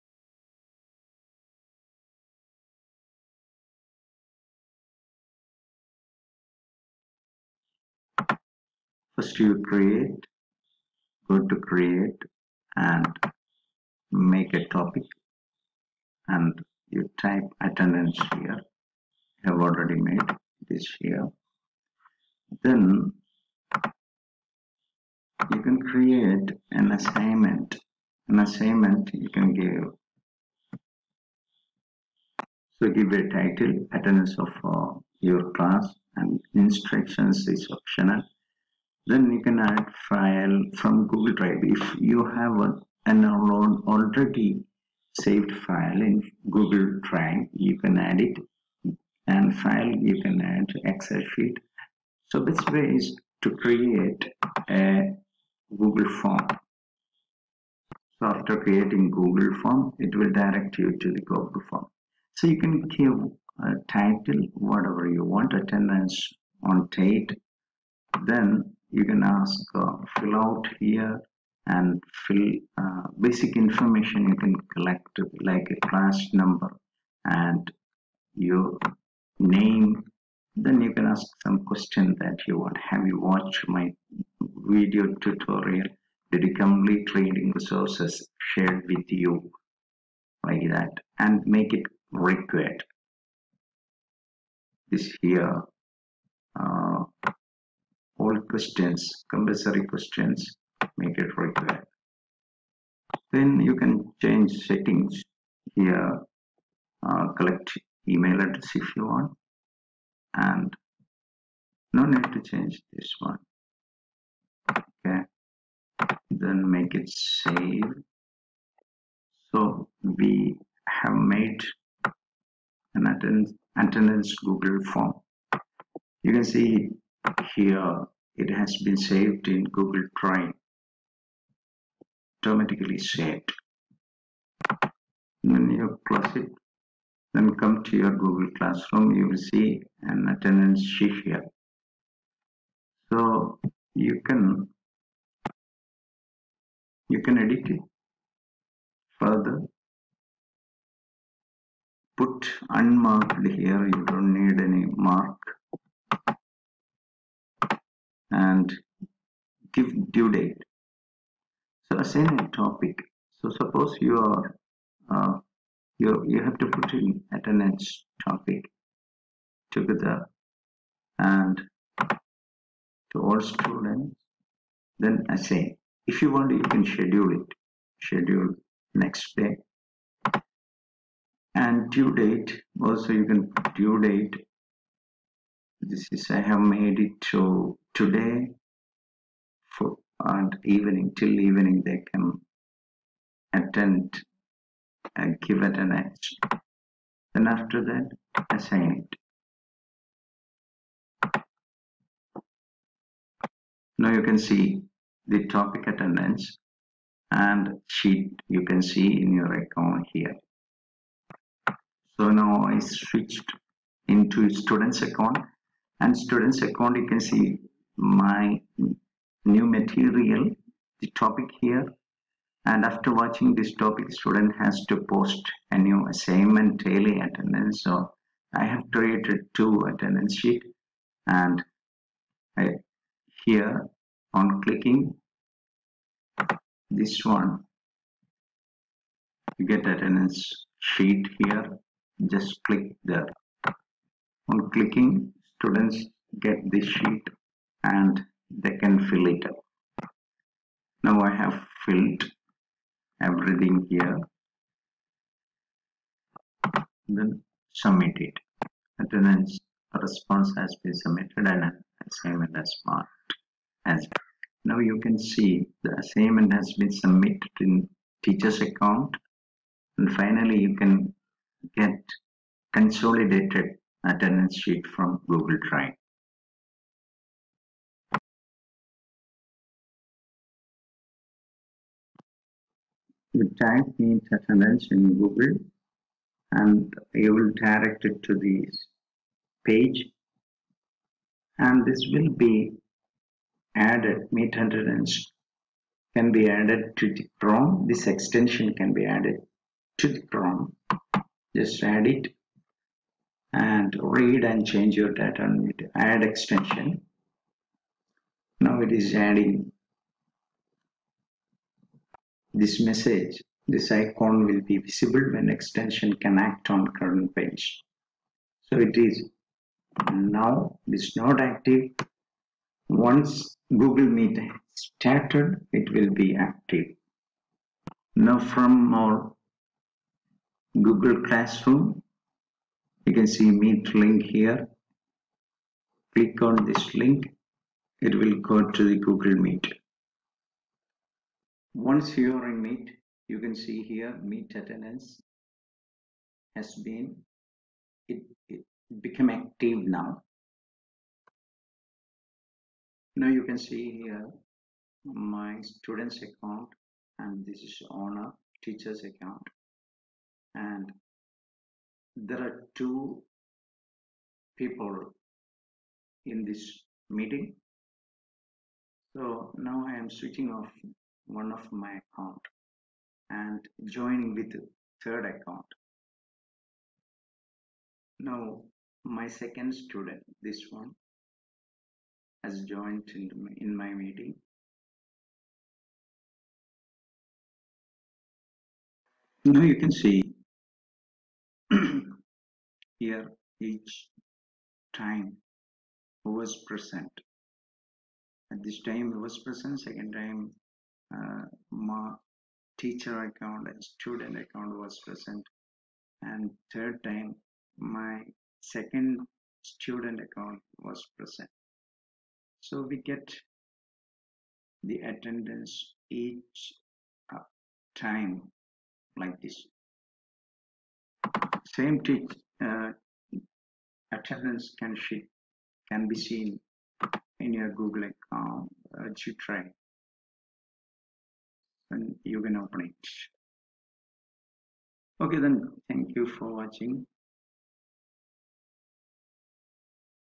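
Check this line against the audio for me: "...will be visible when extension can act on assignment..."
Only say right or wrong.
wrong.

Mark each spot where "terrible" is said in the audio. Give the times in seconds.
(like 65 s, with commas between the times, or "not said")
not said.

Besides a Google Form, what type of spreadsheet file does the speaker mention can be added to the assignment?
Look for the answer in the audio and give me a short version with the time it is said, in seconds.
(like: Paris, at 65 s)
Excel sheet, at 50 s.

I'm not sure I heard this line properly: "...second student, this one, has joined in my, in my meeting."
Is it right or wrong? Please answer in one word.
right.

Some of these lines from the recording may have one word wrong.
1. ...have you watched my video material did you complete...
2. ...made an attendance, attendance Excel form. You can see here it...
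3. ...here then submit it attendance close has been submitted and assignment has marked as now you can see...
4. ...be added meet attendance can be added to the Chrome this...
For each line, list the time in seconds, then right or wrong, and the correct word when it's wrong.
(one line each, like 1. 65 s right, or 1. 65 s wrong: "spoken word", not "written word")
1. 82 s wrong: "tutorial", not "material"
2. 121 s wrong: "Google", not "Excel"
3. 253 s wrong: "response", not "close"
4. 292 s right.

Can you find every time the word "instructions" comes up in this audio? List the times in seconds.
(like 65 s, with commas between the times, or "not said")
36 s.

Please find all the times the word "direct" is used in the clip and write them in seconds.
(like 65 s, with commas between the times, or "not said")
60 s, 287 s.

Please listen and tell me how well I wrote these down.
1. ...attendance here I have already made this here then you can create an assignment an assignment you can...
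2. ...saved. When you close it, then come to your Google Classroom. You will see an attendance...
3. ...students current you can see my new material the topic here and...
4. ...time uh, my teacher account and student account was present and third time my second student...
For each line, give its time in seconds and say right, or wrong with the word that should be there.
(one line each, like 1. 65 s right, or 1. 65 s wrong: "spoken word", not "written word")
1. 17 s right
2. 132 s right
3. 216 s wrong: "account", not "current"
4. 400 s right.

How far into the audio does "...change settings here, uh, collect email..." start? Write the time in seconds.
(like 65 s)
104 s.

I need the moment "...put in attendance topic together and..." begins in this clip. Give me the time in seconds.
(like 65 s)
166 s.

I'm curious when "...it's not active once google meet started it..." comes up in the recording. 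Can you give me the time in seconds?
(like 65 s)
320 s.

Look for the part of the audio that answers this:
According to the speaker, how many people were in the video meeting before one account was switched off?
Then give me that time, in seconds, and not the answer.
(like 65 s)
362 s.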